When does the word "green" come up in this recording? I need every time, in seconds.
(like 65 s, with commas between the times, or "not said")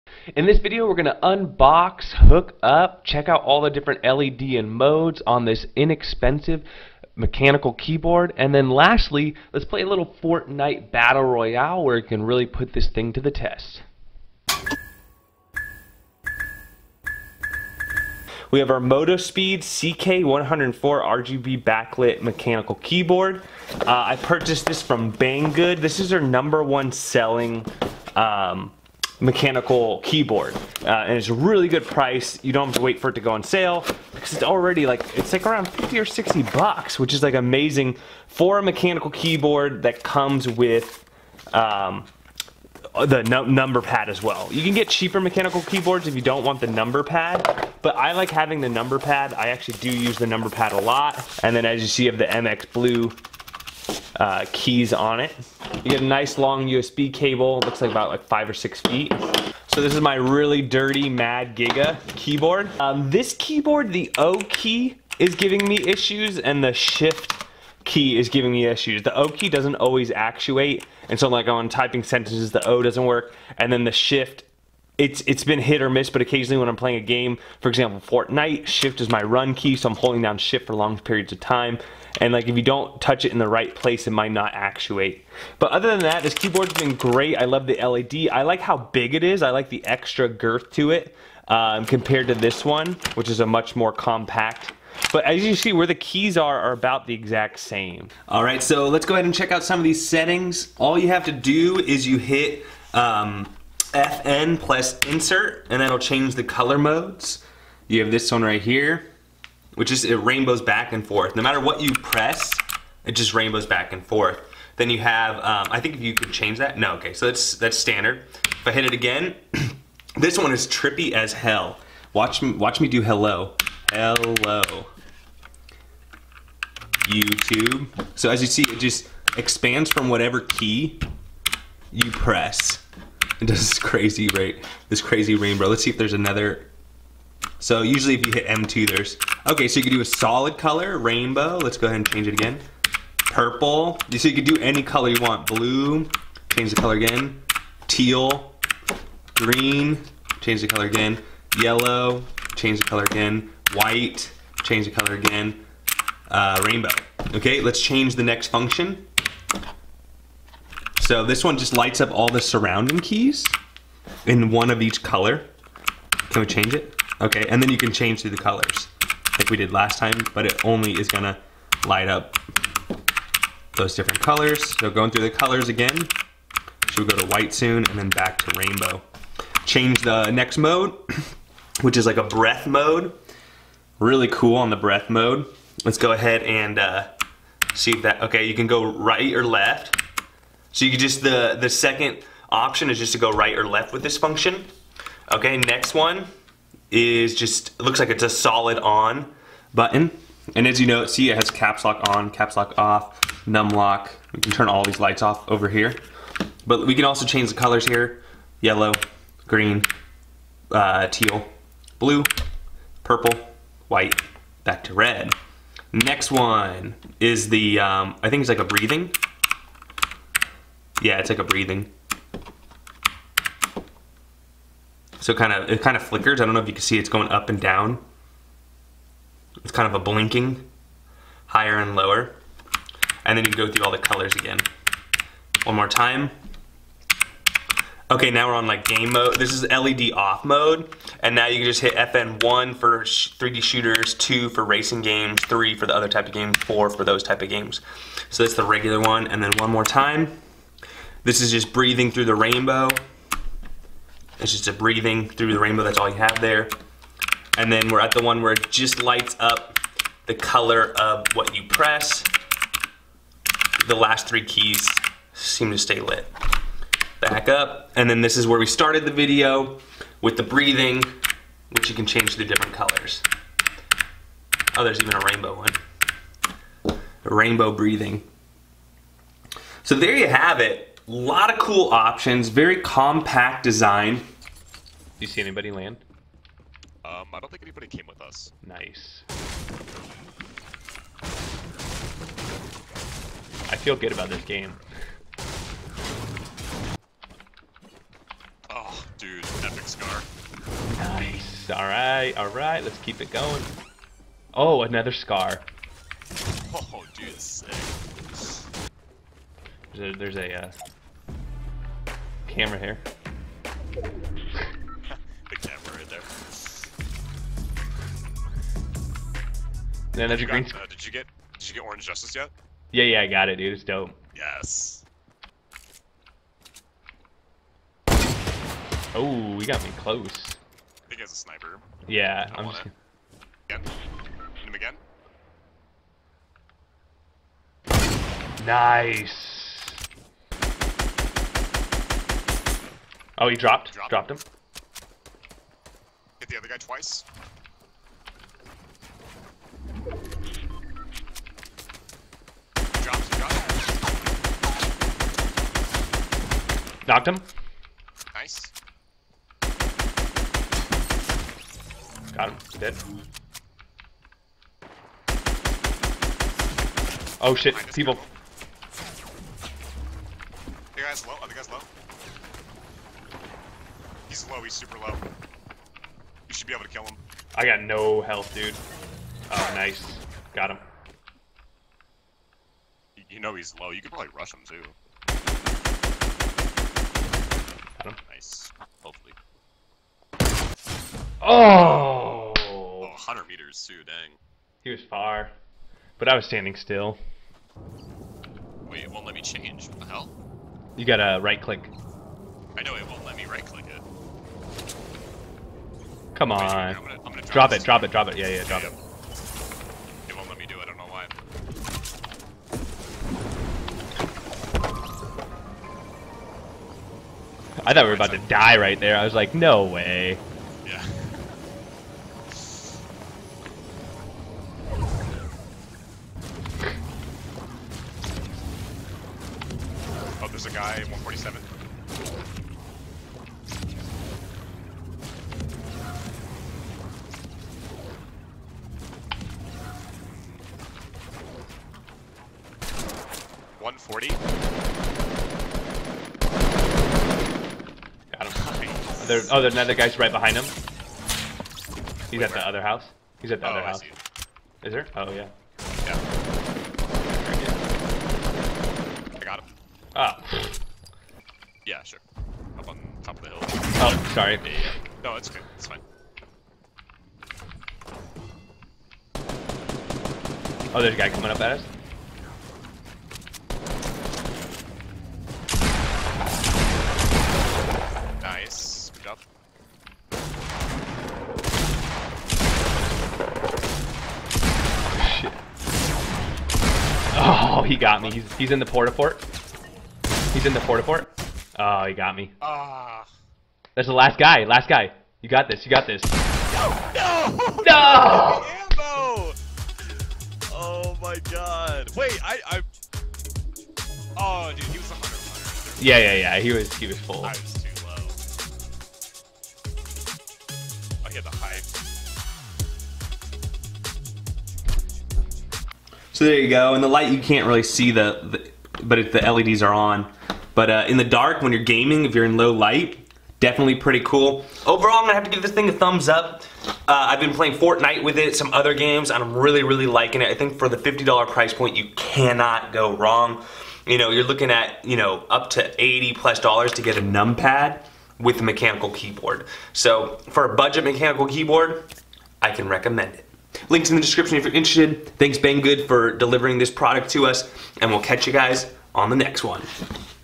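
149 s, 209 s, 320 s.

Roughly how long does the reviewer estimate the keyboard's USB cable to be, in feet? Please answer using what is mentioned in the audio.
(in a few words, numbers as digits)
5 or 6 feet.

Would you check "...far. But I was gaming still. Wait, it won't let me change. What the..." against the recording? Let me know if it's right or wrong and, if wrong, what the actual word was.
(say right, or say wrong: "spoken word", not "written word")
wrong: "standing", not "gaming".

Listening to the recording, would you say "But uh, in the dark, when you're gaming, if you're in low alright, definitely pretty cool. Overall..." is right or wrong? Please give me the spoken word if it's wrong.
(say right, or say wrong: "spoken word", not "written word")
wrong: "light", not "alright".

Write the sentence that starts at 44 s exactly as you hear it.
You can get cheaper mechanical keyboards if you don't want the number pad, but I like having the number pad.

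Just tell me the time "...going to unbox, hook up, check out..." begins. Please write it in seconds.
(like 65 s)
0 s.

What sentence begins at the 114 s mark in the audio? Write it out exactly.
Then you have, um, I think if you could change that.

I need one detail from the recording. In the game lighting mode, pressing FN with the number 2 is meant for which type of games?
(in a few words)
Racing games.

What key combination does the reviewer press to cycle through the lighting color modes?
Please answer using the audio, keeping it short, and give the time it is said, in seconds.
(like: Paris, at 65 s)
FN plus insert, at 103 s.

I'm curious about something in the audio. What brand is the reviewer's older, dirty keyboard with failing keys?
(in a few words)
Mad Giga.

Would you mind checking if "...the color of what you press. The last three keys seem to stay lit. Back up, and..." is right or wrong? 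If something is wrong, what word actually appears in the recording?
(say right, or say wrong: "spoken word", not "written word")
right.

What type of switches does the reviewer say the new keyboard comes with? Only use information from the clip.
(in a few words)
MX Blue.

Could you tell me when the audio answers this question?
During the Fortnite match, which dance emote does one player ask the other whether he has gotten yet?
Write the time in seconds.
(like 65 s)
321 s.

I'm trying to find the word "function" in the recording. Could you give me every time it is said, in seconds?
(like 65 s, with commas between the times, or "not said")
158 s, 194 s.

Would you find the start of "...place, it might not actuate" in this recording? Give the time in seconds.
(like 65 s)
83 s.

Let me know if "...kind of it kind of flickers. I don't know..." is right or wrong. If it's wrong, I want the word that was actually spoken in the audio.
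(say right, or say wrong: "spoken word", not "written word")
right.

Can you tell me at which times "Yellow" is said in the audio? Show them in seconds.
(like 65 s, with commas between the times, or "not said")
151 s, 208 s.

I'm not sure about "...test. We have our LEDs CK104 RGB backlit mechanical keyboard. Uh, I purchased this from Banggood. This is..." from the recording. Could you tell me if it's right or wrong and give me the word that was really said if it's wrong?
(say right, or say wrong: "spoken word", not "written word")
wrong: "MotoSpeed", not "LEDs".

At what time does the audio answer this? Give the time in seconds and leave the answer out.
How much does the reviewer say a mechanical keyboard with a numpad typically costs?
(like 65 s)
536 s.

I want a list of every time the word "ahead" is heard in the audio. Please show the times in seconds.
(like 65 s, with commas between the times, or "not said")
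99 s, 141 s, 186 s.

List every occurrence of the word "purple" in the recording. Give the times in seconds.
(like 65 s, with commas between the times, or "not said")
143 s, 213 s.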